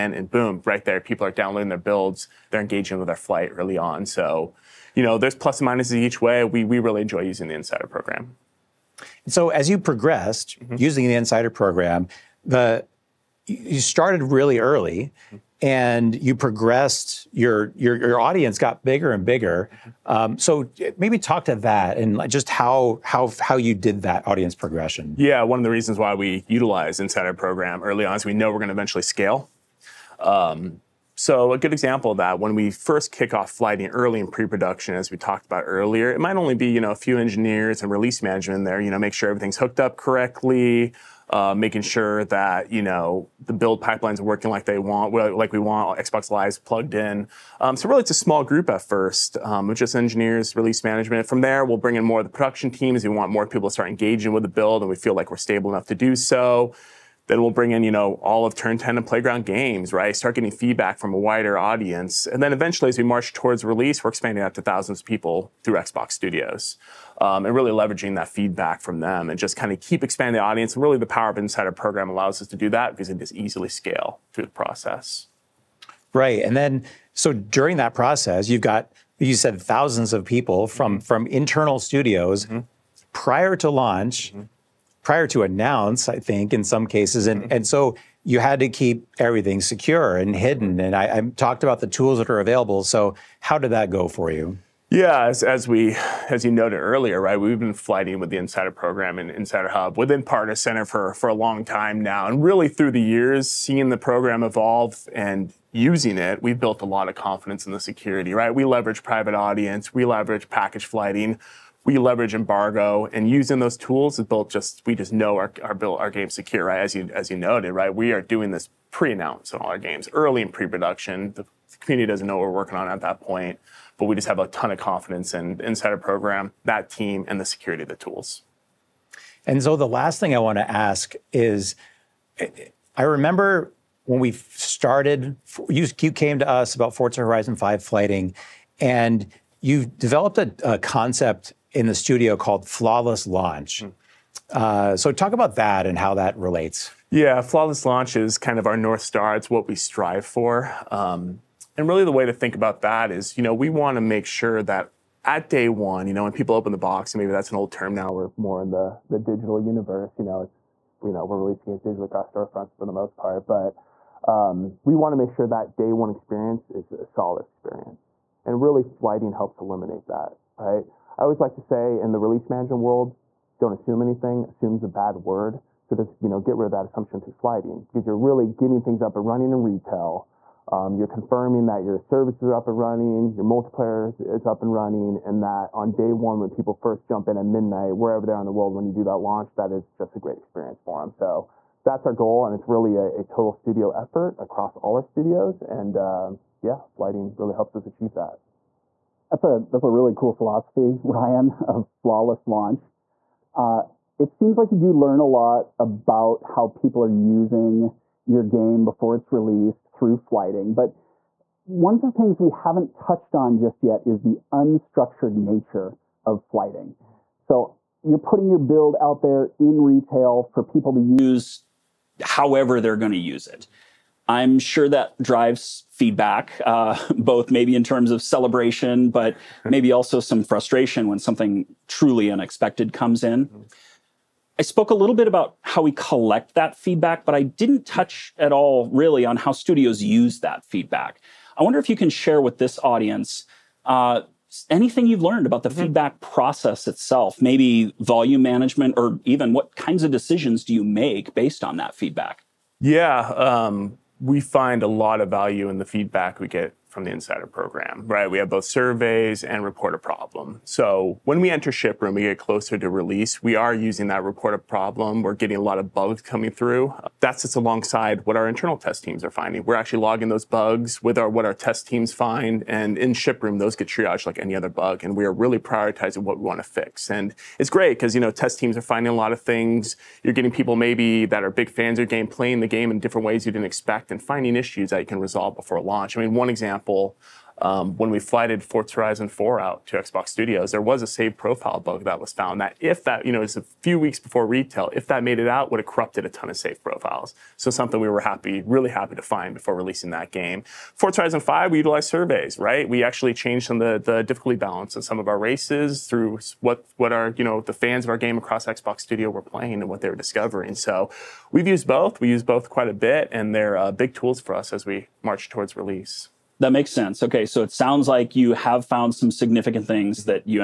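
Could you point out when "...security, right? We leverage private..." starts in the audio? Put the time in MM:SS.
01:47.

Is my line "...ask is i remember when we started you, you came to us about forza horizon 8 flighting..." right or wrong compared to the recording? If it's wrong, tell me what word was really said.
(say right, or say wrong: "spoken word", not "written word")
wrong: "5", not "8".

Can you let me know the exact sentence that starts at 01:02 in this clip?
And then eventually, as we march towards release, we're expanding out to thousands of people through Xbox Studios.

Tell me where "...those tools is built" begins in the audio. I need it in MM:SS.
01:53.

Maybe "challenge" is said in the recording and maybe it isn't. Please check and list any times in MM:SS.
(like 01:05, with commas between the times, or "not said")
not said.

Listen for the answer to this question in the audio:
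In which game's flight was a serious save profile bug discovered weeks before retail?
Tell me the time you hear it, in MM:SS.
04:48.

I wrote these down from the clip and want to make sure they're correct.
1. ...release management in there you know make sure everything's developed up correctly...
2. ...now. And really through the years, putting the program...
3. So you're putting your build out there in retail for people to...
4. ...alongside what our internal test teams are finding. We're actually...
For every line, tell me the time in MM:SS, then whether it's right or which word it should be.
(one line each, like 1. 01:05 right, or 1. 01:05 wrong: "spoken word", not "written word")
1. 00:37 wrong: "hooked", not "developed"
2. 01:41 wrong: "seeing", not "putting"
3. 03:37 right
4. 04:27 right.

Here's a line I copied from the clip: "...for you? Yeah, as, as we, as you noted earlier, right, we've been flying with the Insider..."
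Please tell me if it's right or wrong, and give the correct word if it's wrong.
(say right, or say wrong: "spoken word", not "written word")
right.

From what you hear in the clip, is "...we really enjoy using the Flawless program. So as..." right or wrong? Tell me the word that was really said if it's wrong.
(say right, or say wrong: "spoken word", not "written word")
wrong: "Insider", not "Flawless".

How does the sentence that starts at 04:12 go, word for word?
Yeah, um, we find a lot of value in the feedback we get from the Insider Program, right?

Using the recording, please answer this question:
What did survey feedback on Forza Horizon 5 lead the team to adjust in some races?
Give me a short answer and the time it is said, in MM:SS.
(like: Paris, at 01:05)
Difficulty balance, at 05:04.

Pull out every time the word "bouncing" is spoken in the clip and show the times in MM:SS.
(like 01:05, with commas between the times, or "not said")
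not said.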